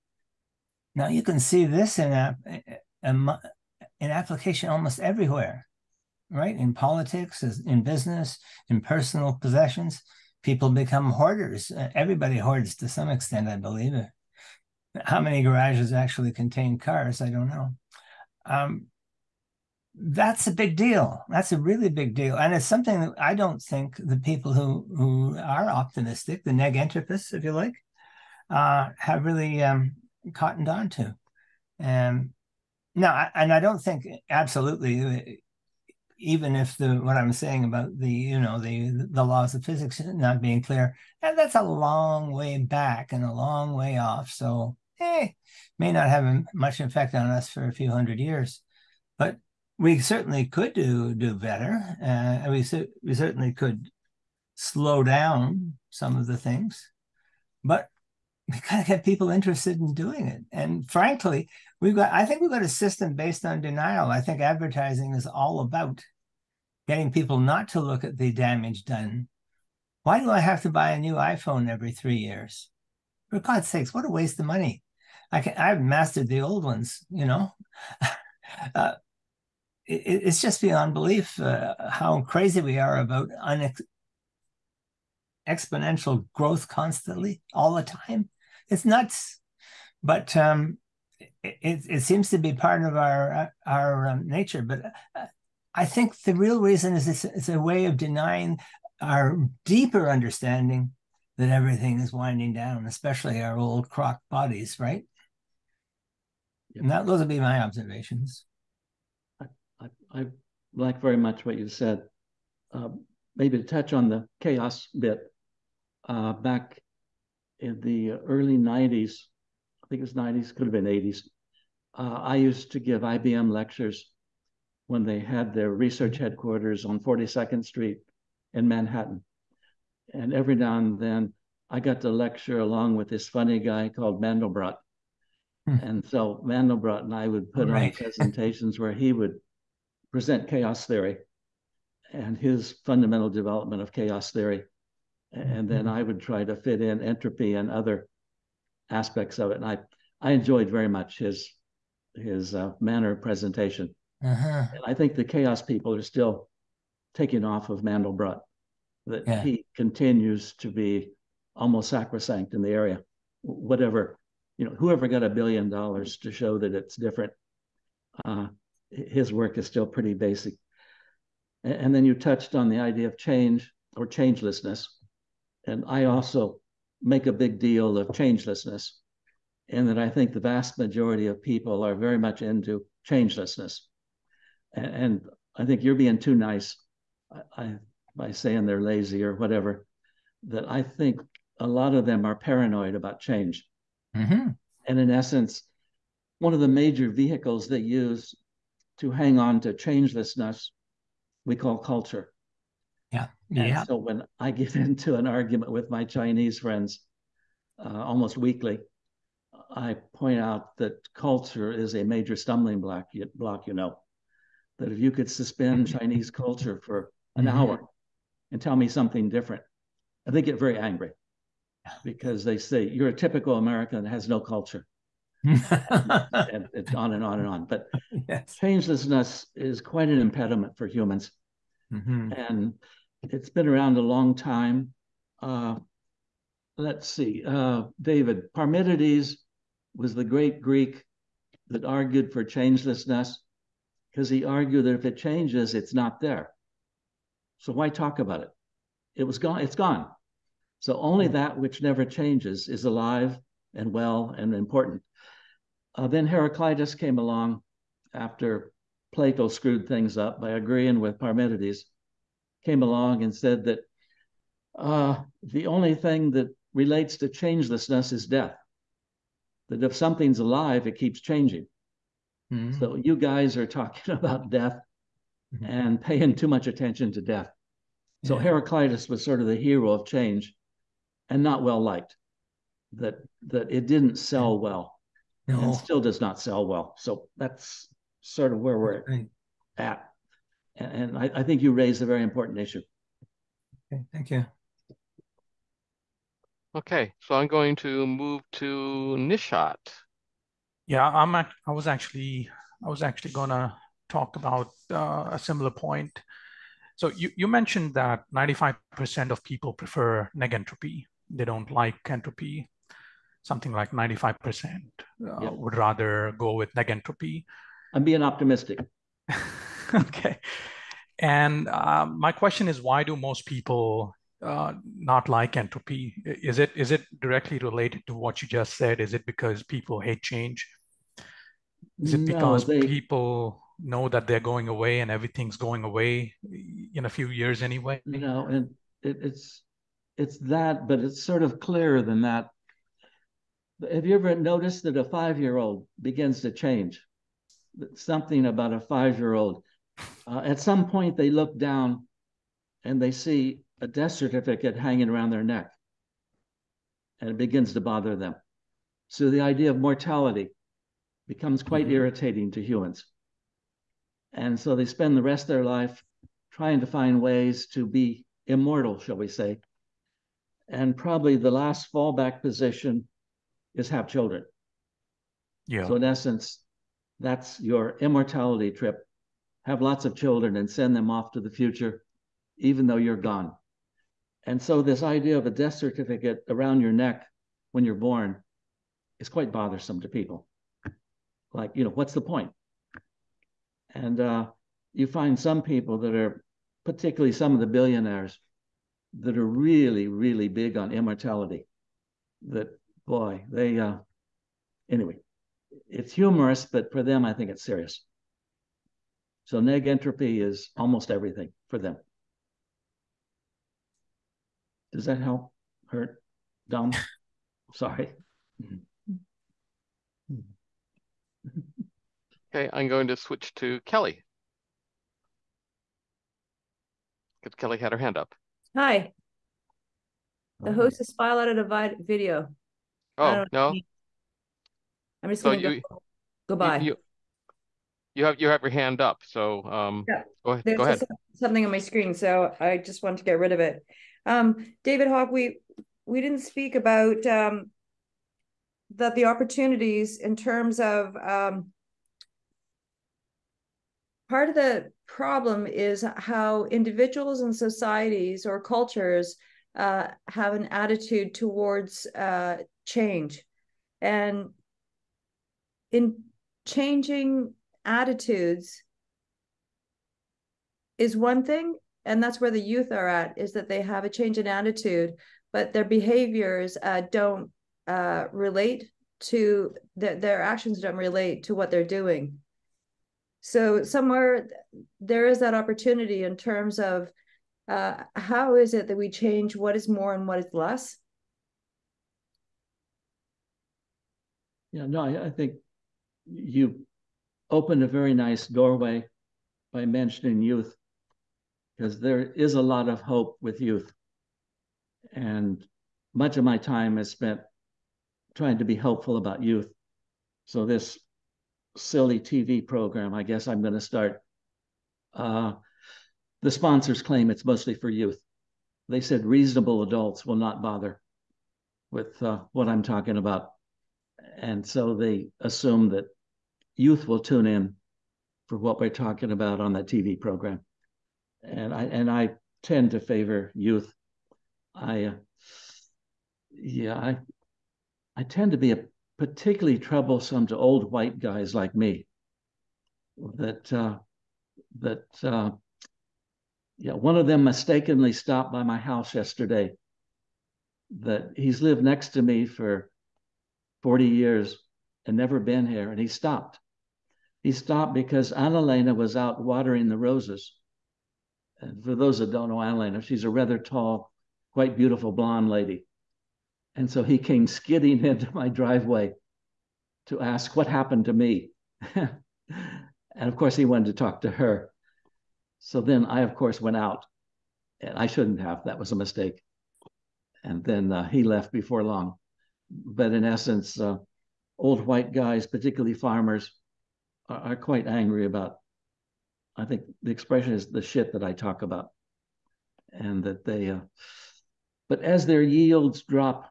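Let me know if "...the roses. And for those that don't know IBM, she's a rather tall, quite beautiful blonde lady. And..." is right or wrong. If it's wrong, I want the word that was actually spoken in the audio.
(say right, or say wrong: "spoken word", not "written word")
wrong: "Annalena", not "IBM".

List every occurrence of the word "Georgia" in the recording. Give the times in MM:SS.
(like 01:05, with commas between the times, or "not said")
not said.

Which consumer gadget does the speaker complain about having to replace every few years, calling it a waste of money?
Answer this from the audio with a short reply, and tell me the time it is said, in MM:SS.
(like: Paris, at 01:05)
iPhone, at 01:11.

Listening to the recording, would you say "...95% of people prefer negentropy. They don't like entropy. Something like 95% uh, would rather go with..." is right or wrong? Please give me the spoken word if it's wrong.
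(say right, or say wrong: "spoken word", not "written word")
right.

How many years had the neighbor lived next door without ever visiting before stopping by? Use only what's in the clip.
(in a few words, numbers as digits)
40.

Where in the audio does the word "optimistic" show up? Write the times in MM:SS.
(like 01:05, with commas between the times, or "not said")
00:25, 05:18.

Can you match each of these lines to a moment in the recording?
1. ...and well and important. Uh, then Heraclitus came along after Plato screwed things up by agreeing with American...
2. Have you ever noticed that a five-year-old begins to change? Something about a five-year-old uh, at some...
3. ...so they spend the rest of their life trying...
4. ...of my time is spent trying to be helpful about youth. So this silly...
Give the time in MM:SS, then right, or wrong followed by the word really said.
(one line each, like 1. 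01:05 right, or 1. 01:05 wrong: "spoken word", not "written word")
1. 04:13 wrong: "Parmenides", not "American"
2. 05:43 right
3. 06:04 right
4. 08:26 right.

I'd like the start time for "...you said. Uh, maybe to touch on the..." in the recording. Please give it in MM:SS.
01:51.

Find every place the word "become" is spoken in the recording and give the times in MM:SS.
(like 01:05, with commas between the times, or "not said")
00:10, 06:01.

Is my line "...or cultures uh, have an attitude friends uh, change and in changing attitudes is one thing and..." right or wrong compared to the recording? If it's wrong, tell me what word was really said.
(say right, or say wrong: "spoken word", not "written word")
wrong: "towards", not "friends".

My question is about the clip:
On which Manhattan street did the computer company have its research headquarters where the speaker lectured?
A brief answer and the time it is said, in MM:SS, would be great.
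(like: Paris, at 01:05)
42nd Street, at 02:06.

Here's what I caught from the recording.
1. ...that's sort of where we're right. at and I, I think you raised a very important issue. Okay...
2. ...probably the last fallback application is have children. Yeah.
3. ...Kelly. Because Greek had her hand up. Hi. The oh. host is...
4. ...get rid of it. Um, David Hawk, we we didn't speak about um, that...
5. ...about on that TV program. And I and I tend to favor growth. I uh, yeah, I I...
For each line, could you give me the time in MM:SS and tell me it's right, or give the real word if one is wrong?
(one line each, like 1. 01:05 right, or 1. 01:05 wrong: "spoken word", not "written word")
1. 04:47 right
2. 06:10 wrong: "position", not "application"
3. 07:03 wrong: "Kelly", not "Greek"
4. 07:23 right
5. 08:49 wrong: "youth", not "growth".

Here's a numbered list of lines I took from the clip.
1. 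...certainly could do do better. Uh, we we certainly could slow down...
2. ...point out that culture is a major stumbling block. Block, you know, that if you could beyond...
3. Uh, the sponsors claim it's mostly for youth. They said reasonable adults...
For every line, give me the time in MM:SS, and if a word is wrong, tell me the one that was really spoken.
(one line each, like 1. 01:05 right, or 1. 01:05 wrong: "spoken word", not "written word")
1. 00:49 right
2. 03:30 wrong: "suspend", not "beyond"
3. 08:35 right.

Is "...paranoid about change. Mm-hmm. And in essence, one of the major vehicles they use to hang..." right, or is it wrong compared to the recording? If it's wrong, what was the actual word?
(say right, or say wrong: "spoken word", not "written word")
right.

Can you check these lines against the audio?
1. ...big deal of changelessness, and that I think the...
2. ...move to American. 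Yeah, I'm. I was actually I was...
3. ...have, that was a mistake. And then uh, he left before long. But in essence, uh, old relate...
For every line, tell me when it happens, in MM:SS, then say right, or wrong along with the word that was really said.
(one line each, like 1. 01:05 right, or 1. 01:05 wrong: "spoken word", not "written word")
1. 02:57 right
2. 04:58 wrong: "Nishat", not "American"
3. 09:38 wrong: "white", not "relate".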